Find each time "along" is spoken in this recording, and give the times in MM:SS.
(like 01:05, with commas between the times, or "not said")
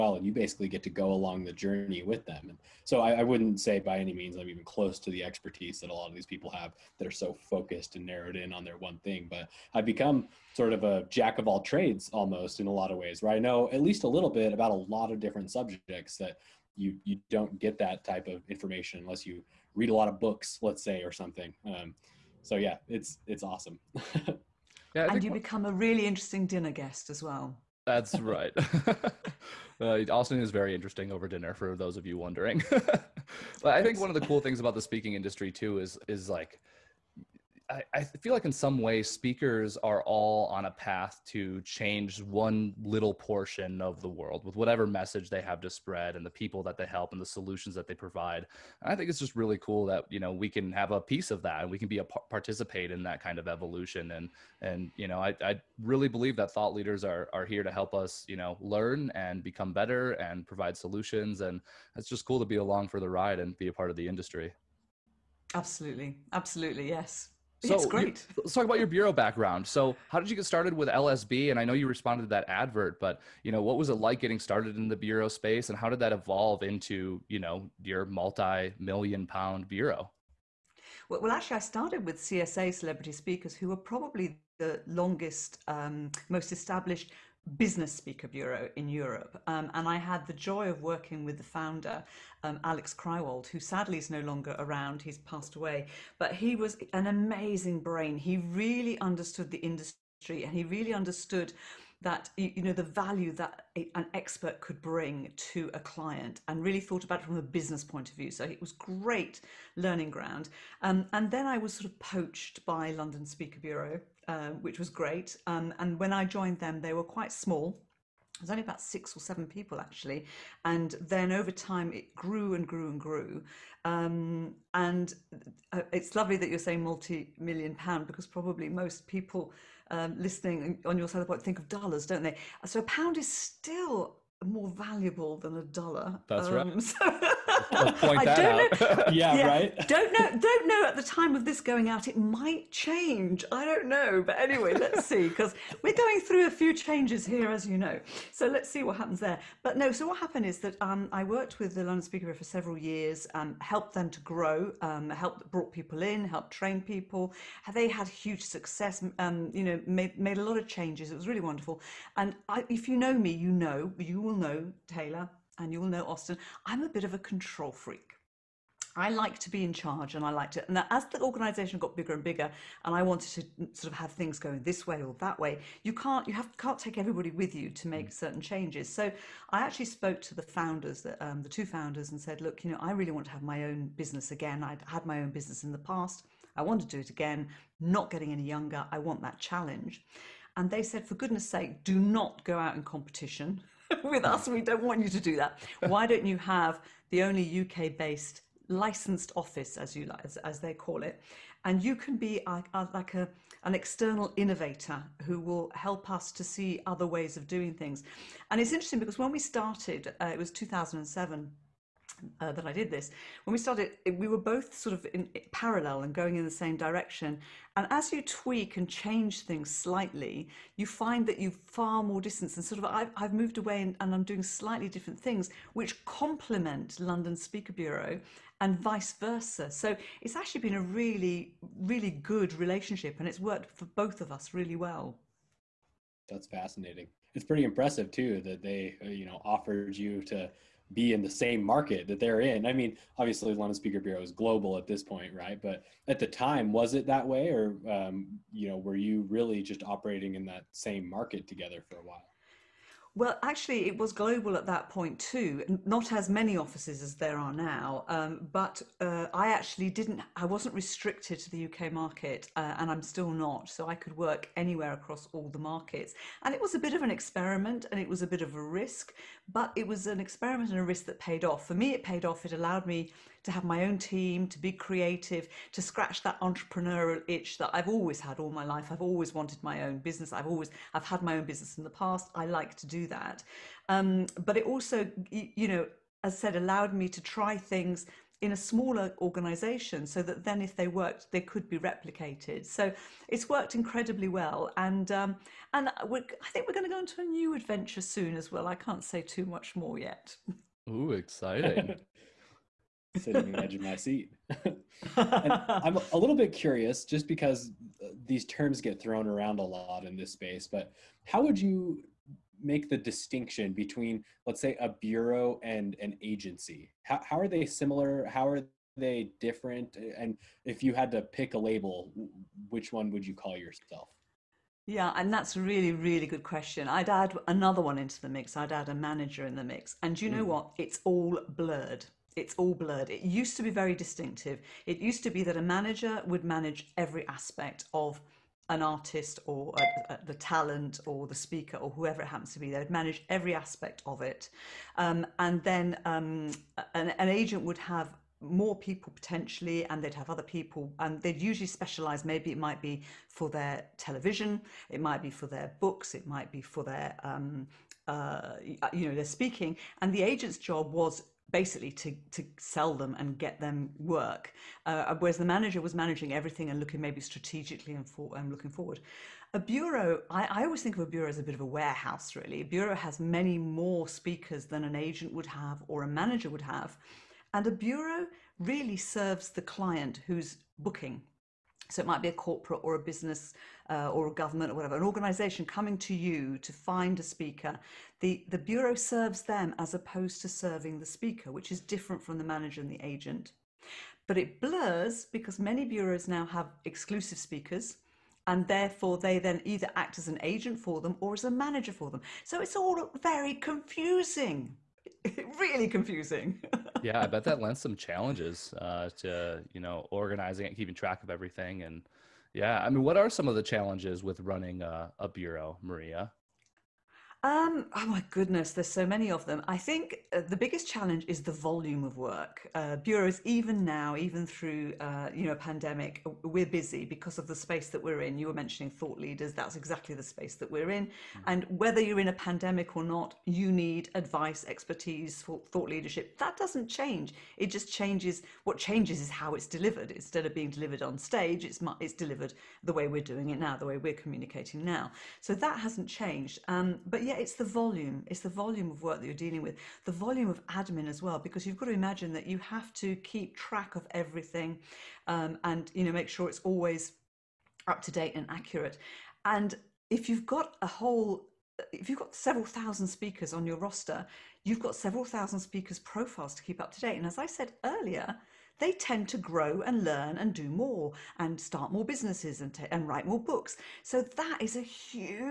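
00:01, 01:02.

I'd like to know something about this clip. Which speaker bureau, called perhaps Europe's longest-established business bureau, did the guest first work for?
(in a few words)
CSA Celebrity Speakers.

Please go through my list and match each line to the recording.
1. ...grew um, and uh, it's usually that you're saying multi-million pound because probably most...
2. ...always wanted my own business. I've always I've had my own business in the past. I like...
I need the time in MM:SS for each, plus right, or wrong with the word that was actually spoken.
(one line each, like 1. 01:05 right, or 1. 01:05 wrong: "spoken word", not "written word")
1. 02:03 wrong: "lovely", not "usually"
2. 04:39 right.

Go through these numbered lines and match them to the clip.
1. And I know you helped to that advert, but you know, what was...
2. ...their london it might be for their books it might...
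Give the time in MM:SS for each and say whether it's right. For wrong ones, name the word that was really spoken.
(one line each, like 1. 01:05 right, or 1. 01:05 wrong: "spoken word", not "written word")
1. 01:11 wrong: "responded", not "helped"
2. 05:53 wrong: "television", not "london".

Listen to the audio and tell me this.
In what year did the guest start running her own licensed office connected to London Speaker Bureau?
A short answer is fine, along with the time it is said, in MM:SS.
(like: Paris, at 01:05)
2007, at 03:30.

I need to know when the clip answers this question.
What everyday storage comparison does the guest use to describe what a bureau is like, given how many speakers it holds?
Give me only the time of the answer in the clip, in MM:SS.
06:11.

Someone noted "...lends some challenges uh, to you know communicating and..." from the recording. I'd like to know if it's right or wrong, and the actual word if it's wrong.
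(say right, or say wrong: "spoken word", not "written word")
wrong: "organizing", not "communicating".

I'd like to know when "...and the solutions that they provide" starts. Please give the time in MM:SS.
00:47.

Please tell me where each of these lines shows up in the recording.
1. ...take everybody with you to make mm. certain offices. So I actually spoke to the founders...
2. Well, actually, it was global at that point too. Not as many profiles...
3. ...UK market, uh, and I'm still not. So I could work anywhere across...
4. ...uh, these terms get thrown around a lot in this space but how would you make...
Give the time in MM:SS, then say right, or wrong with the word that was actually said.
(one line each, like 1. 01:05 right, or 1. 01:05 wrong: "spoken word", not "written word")
1. 02:56 wrong: "changes", not "offices"
2. 04:13 wrong: "offices", not "profiles"
3. 04:21 right
4. 05:08 right.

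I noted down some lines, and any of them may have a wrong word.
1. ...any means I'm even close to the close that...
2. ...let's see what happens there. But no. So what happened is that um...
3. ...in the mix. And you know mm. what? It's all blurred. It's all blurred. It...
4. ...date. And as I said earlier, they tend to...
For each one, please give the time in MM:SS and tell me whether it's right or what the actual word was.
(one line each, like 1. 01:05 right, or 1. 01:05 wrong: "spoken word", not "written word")
1. 00:03 wrong: "expertise", not "close"
2. 02:28 right
3. 05:29 right
4. 07:47 right.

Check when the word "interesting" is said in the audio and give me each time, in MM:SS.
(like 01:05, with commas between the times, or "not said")
00:26, 00:30, 03:28.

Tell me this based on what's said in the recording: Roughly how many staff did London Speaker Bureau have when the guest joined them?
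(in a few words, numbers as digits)
six or seven.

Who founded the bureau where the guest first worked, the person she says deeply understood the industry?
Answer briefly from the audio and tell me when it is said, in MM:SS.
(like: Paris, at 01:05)
Alex Krywald, at 01:32.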